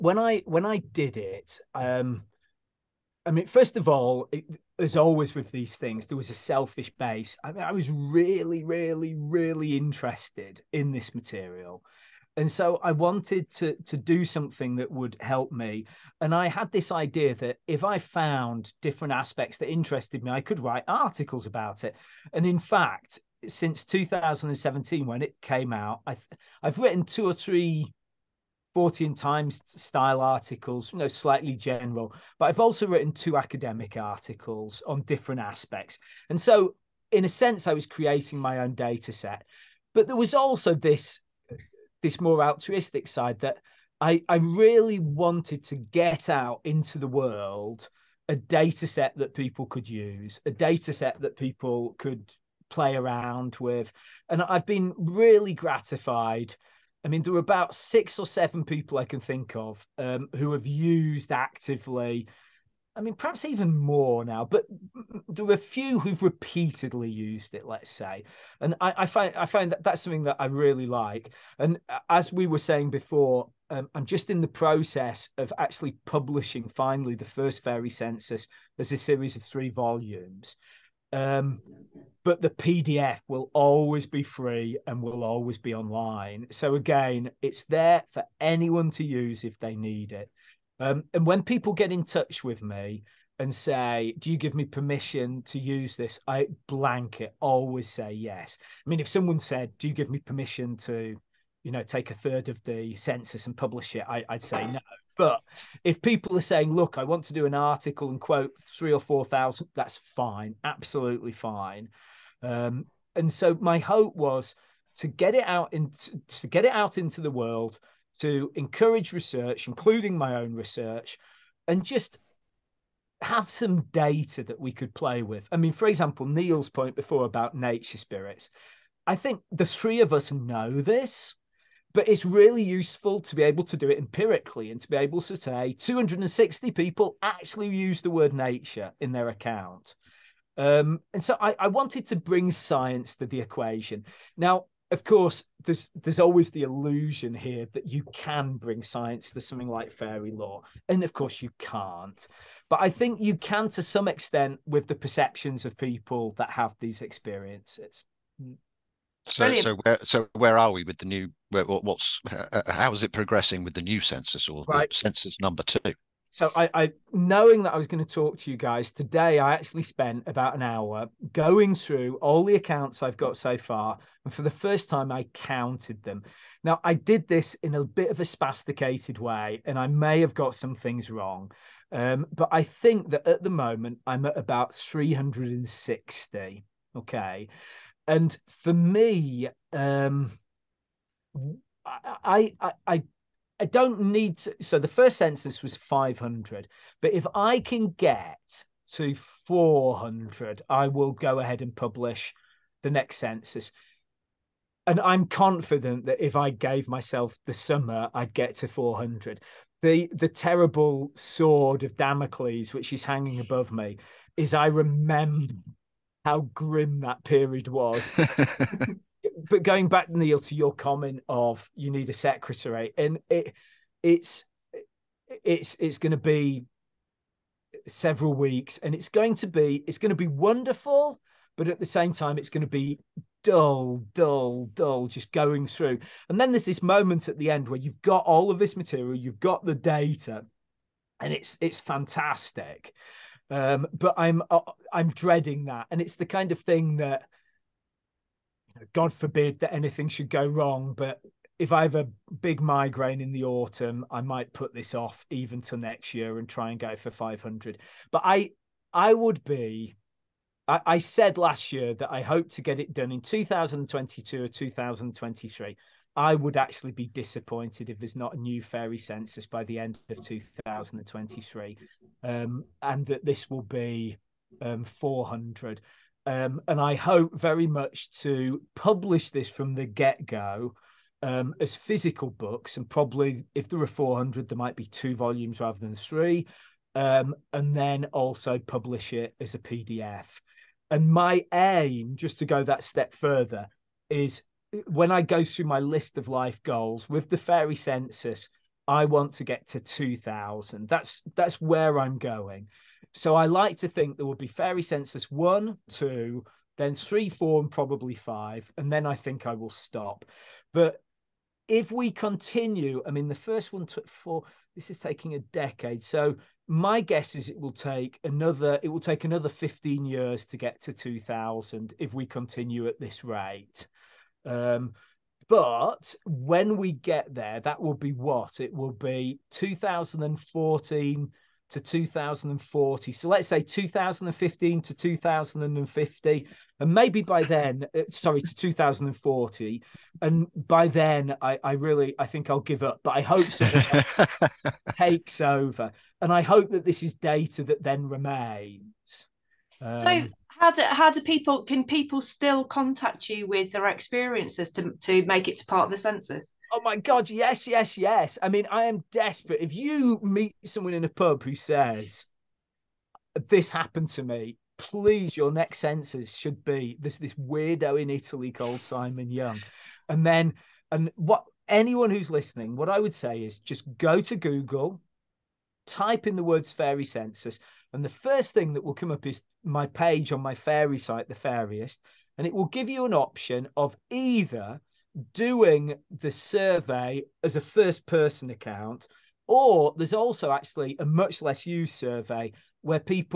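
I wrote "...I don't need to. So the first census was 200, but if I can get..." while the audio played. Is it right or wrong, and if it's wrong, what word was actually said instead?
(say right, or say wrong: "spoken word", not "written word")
wrong: "500", not "200".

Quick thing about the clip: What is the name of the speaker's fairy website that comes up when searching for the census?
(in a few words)
The Fairyist.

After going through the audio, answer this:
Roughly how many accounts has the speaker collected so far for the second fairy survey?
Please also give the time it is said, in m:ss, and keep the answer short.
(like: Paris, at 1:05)
360, at 3:04.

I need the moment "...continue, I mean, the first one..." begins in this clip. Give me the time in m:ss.
5:12.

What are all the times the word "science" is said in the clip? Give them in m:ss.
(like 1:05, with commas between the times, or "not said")
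2:22, 2:28.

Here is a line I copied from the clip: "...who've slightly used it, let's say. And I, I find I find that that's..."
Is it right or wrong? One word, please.
wrong.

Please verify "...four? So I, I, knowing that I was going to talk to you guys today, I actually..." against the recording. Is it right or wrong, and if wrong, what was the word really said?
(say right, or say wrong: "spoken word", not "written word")
wrong: "two", not "four".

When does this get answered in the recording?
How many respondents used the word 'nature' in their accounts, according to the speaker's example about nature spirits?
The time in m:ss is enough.
2:15.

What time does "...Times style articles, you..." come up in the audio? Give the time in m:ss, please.
0:29.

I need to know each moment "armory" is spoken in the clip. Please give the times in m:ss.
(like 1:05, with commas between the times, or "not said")
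not said.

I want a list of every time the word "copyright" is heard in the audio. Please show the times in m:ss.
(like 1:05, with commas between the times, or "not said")
not said.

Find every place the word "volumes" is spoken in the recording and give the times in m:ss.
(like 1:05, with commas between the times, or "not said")
1:19, 4:45.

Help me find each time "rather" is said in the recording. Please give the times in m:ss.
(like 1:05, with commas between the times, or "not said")
4:45.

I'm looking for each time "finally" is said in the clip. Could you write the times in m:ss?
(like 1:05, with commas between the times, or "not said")
1:16.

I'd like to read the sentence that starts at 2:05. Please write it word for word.
I mean, for example, Neil's point before about nature spirits.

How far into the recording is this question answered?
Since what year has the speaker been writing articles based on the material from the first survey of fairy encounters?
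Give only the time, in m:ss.
0:23.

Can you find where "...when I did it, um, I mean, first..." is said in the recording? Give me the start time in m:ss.
0:00.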